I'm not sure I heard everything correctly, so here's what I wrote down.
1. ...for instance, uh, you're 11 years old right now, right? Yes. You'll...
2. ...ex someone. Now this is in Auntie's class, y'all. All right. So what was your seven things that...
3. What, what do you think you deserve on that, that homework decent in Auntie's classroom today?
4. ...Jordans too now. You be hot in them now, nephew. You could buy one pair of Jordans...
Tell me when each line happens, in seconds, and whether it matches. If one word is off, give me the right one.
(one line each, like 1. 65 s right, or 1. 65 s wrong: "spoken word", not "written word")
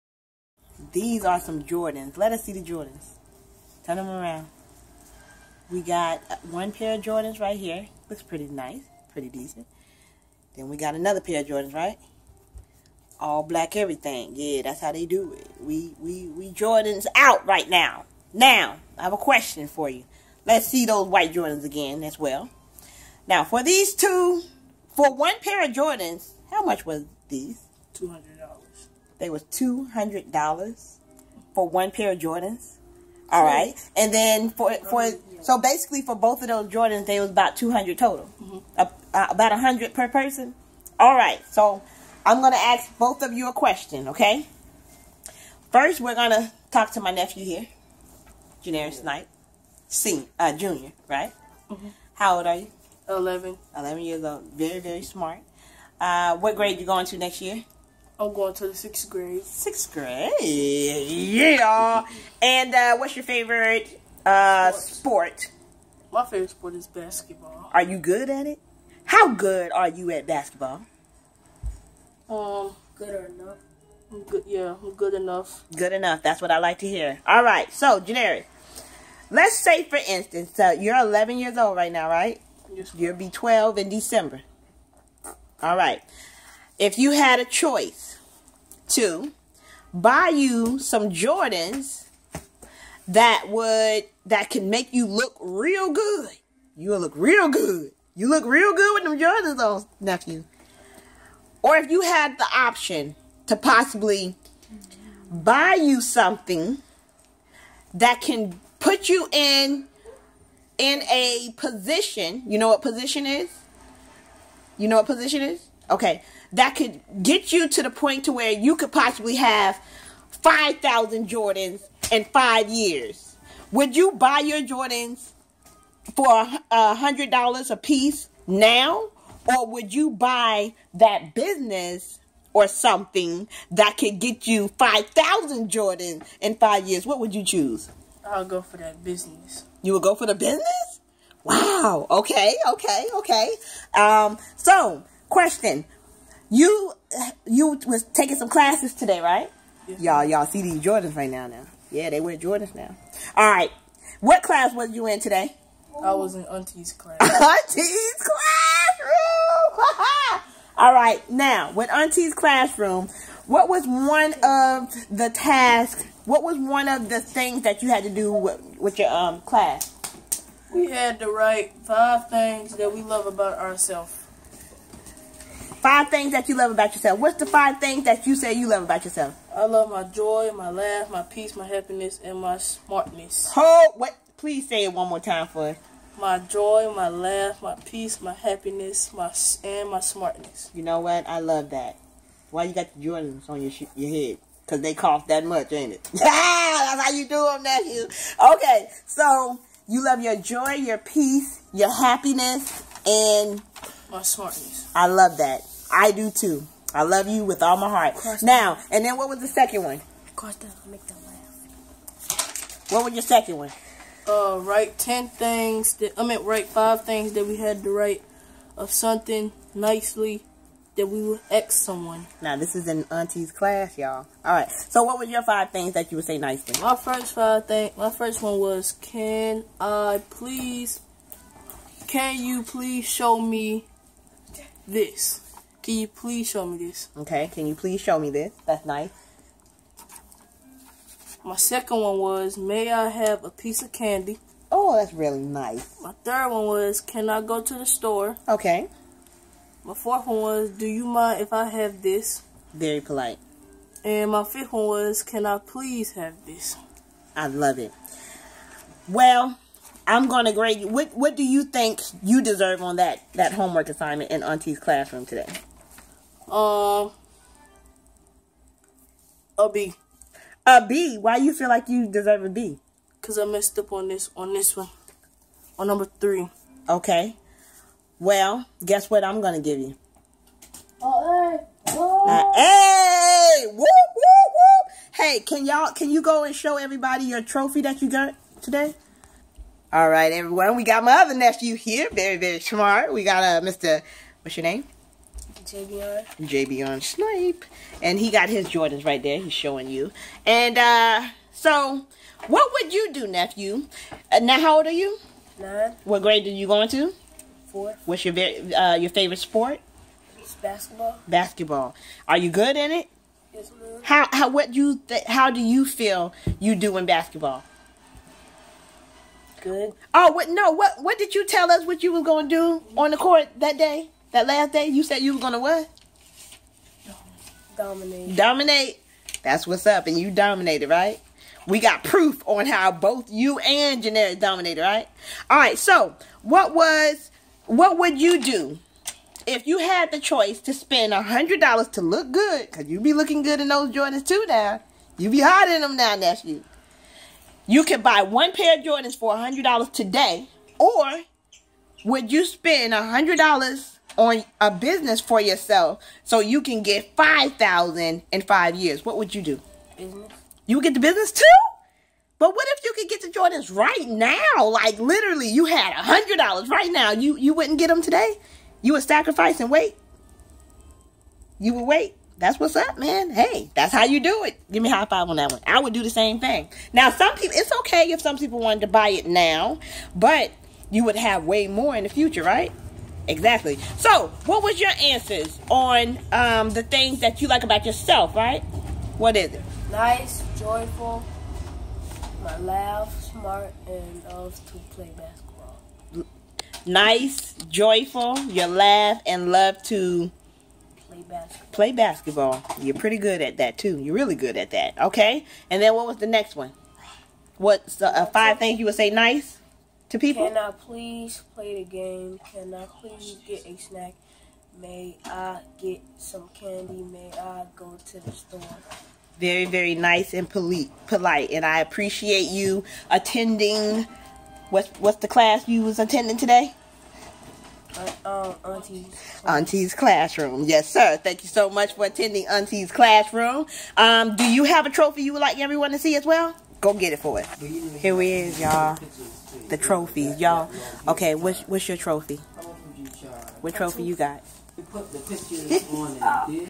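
1. 79 s right
2. 221 s wrong: "five", not "seven"
3. 260 s wrong: "assignment", not "decent"
4. 343 s right.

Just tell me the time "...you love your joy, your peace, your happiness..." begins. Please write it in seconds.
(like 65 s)
199 s.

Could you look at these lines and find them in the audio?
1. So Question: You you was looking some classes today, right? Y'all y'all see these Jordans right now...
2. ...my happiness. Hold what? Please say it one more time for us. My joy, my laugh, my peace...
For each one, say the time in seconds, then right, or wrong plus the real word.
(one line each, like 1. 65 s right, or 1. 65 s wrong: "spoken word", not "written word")
1. 144 s wrong: "taking", not "looking"
2. 182 s wrong: "smartness", not "happiness".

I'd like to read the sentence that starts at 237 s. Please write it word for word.
Okay, can you please show me this?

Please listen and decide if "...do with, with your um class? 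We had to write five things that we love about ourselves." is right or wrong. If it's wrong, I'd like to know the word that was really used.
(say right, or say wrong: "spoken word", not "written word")
right.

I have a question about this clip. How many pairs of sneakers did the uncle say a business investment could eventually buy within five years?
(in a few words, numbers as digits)
5,000.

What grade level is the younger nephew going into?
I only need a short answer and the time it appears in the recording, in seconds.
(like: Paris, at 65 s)
Fourth, at 307 s.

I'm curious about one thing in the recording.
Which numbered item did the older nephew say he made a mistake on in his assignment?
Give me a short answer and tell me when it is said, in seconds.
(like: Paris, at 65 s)
Number three, at 275 s.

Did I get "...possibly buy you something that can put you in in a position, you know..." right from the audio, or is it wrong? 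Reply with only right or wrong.
right.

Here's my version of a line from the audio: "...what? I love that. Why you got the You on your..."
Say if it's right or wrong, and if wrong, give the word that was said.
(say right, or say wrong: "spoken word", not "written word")
wrong: "Jordans", not "You".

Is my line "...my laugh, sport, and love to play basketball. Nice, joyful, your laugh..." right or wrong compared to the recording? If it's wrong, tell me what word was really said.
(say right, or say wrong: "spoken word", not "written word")
wrong: "smart", not "sport".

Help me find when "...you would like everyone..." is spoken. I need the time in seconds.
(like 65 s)
435 s.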